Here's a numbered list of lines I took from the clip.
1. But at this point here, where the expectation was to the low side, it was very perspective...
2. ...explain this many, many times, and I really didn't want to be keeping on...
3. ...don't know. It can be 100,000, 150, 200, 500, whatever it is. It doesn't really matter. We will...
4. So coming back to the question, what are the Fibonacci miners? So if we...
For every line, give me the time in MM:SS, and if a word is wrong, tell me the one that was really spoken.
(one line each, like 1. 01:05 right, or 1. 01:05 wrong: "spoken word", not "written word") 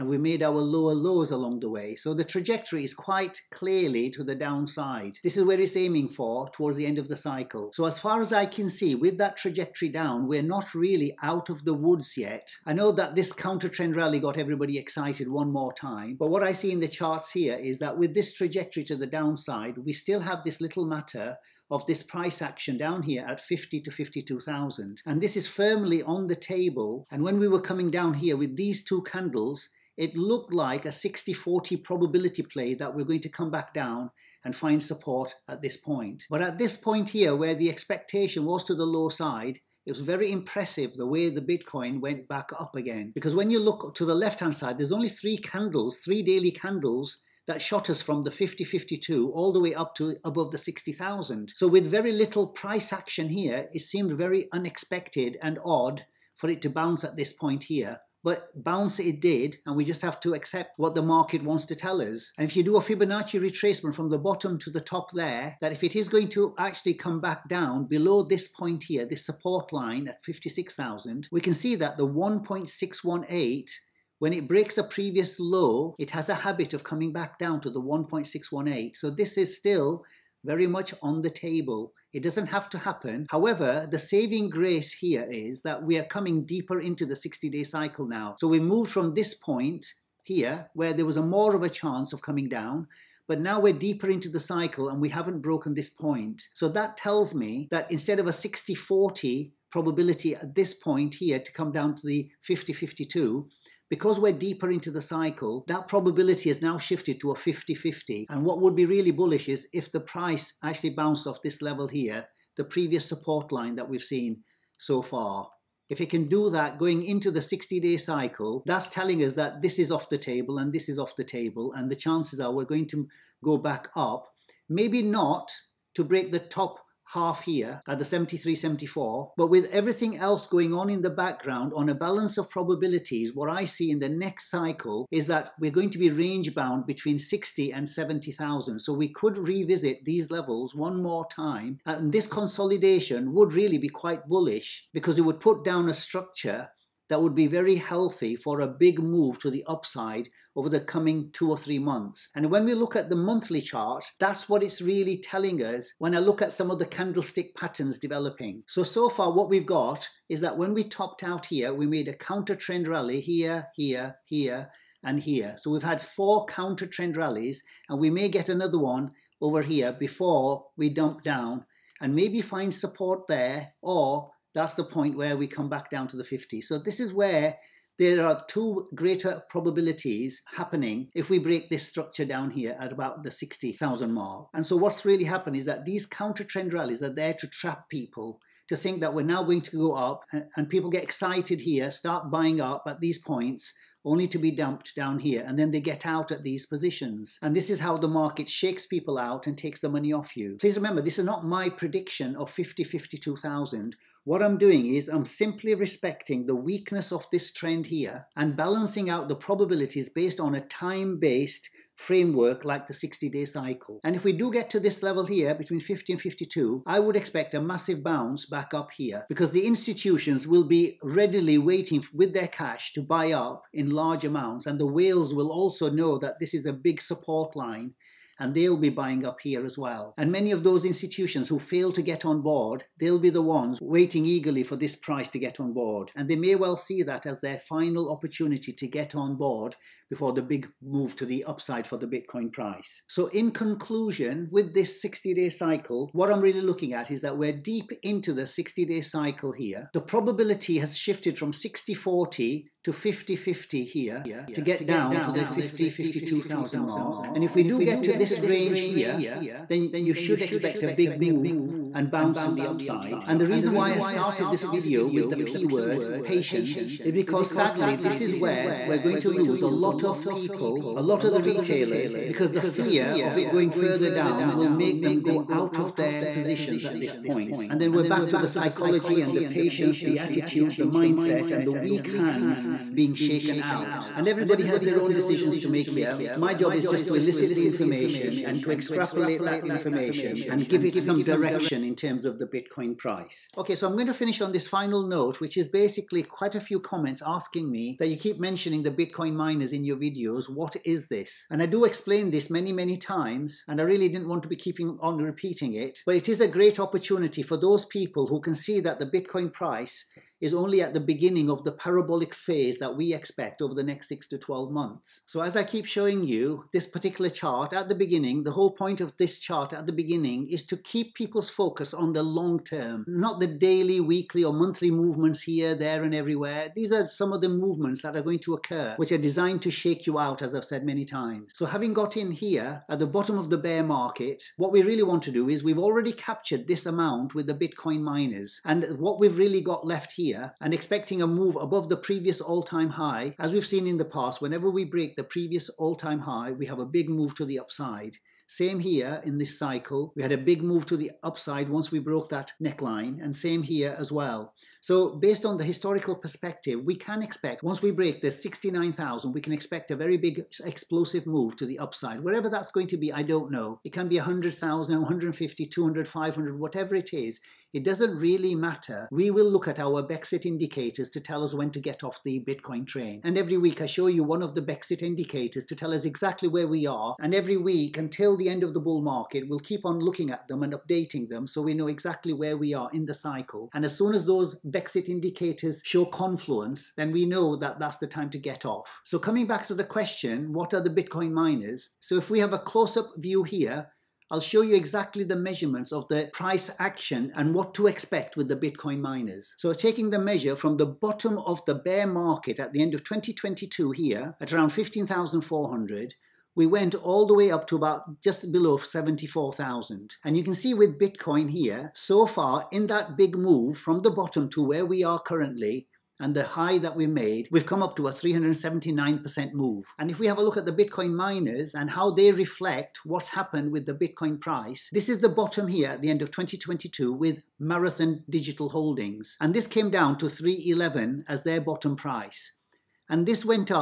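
1. 00:36 wrong: "impressive", not "perspective"
2. 05:01 right
3. 06:03 right
4. 06:29 wrong: "Bitcoin", not "Fibonacci".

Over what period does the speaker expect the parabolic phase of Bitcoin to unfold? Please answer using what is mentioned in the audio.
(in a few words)
6 to 12 months.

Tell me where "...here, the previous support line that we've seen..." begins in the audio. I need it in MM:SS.
01:51.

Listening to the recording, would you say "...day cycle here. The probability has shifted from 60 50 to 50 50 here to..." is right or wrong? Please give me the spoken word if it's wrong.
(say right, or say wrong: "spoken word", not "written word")
wrong: "40", not "50".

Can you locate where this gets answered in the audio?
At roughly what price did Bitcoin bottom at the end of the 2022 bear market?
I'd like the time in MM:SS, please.
06:44.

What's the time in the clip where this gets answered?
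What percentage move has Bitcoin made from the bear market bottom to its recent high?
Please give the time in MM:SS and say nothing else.
06:58.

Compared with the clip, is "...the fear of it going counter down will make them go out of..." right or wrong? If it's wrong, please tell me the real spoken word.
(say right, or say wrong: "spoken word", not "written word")
wrong: "further", not "counter".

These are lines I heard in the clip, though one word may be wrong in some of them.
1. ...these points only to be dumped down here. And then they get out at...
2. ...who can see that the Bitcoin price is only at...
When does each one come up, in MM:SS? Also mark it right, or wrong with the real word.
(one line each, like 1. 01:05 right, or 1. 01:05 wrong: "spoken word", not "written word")
1. 03:12 right
2. 05:08 right.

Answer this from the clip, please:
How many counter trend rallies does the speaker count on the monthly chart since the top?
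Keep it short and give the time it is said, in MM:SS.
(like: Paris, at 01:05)
4, at 02:46.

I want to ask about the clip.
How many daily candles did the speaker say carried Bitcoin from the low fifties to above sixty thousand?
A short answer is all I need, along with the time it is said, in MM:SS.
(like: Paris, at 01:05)
3, at 00:45.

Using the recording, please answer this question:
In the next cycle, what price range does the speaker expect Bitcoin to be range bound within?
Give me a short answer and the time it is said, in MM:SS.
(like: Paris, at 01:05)
60,000 to 70,000, at 02:16.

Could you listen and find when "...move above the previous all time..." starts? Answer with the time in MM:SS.
05:41.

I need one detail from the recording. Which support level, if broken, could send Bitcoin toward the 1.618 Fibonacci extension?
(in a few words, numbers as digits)
56,000.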